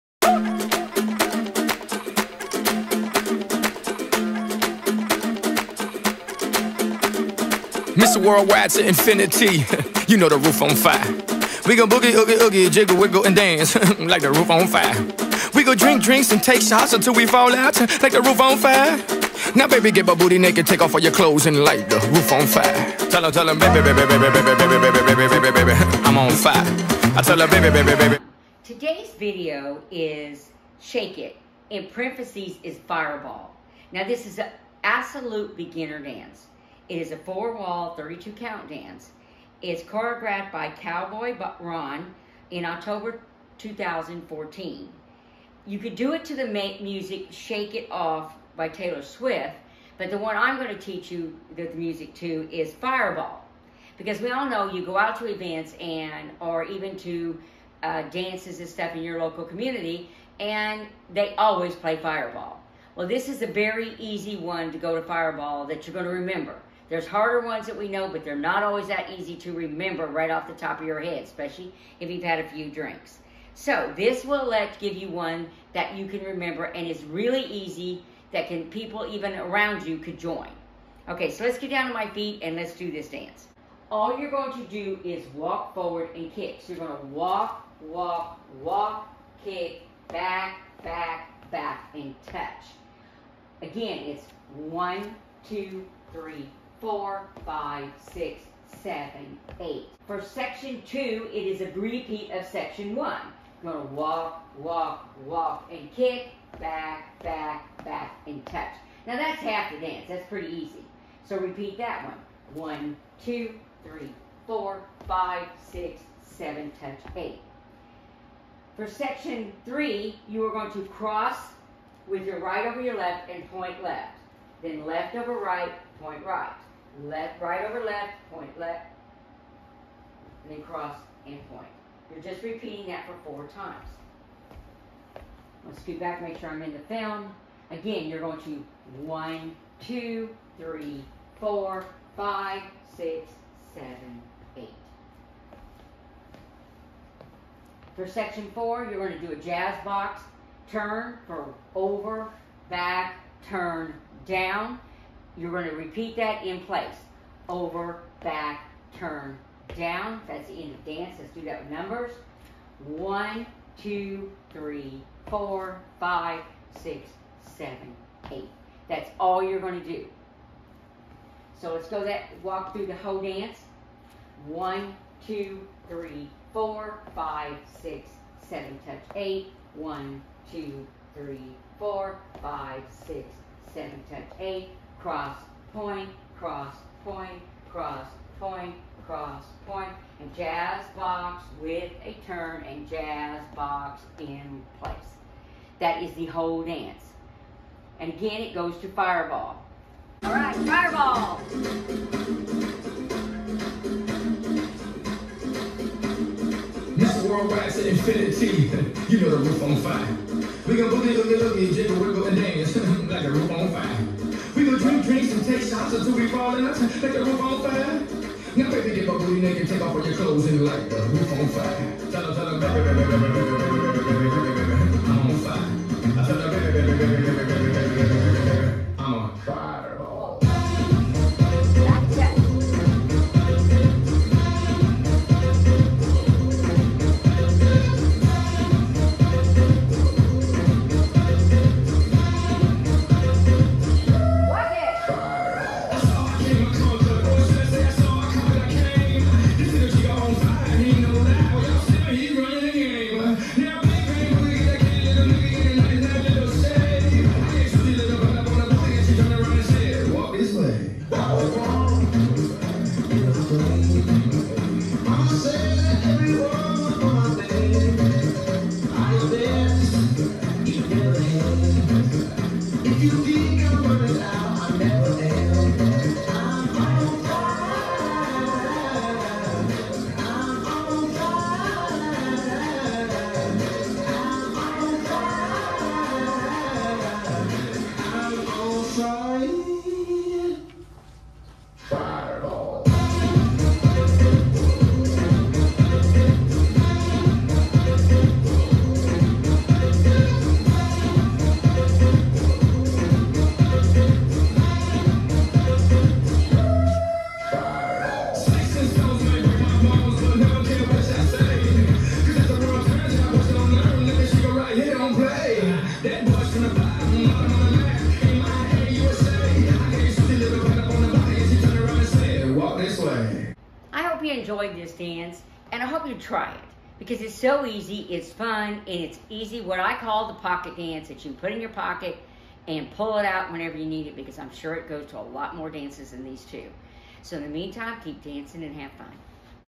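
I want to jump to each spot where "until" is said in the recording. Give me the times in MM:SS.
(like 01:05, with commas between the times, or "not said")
00:16.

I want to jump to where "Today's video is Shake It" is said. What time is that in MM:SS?
00:28.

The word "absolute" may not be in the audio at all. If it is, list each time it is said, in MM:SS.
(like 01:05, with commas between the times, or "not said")
00:34.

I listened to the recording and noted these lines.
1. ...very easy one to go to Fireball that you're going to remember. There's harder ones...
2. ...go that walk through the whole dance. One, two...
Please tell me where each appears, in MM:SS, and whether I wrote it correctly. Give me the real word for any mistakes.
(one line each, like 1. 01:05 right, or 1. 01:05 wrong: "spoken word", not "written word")
1. 01:03 right
2. 02:51 right.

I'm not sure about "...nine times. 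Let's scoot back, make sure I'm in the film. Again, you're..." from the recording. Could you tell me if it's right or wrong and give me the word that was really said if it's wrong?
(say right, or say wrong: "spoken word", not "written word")
wrong: "four", not "nine".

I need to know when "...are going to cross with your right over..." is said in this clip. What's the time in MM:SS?
02:00.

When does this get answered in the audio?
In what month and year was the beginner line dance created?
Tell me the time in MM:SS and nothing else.
00:42.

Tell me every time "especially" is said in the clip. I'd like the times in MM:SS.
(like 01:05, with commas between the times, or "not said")
01:11.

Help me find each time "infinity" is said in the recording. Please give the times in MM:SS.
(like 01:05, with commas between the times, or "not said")
00:08, 03:27.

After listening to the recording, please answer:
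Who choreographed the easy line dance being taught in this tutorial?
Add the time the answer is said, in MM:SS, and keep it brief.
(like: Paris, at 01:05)
Cowboy Ron, at 00:40.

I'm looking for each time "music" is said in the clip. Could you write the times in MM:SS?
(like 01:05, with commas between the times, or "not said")
00:46, 00:51.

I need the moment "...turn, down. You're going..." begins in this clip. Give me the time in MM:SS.
02:33.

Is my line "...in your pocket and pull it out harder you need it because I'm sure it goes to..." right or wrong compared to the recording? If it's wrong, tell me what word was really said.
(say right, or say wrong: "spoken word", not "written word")
wrong: "whenever", not "harder".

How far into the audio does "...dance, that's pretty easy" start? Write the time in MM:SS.
01:49.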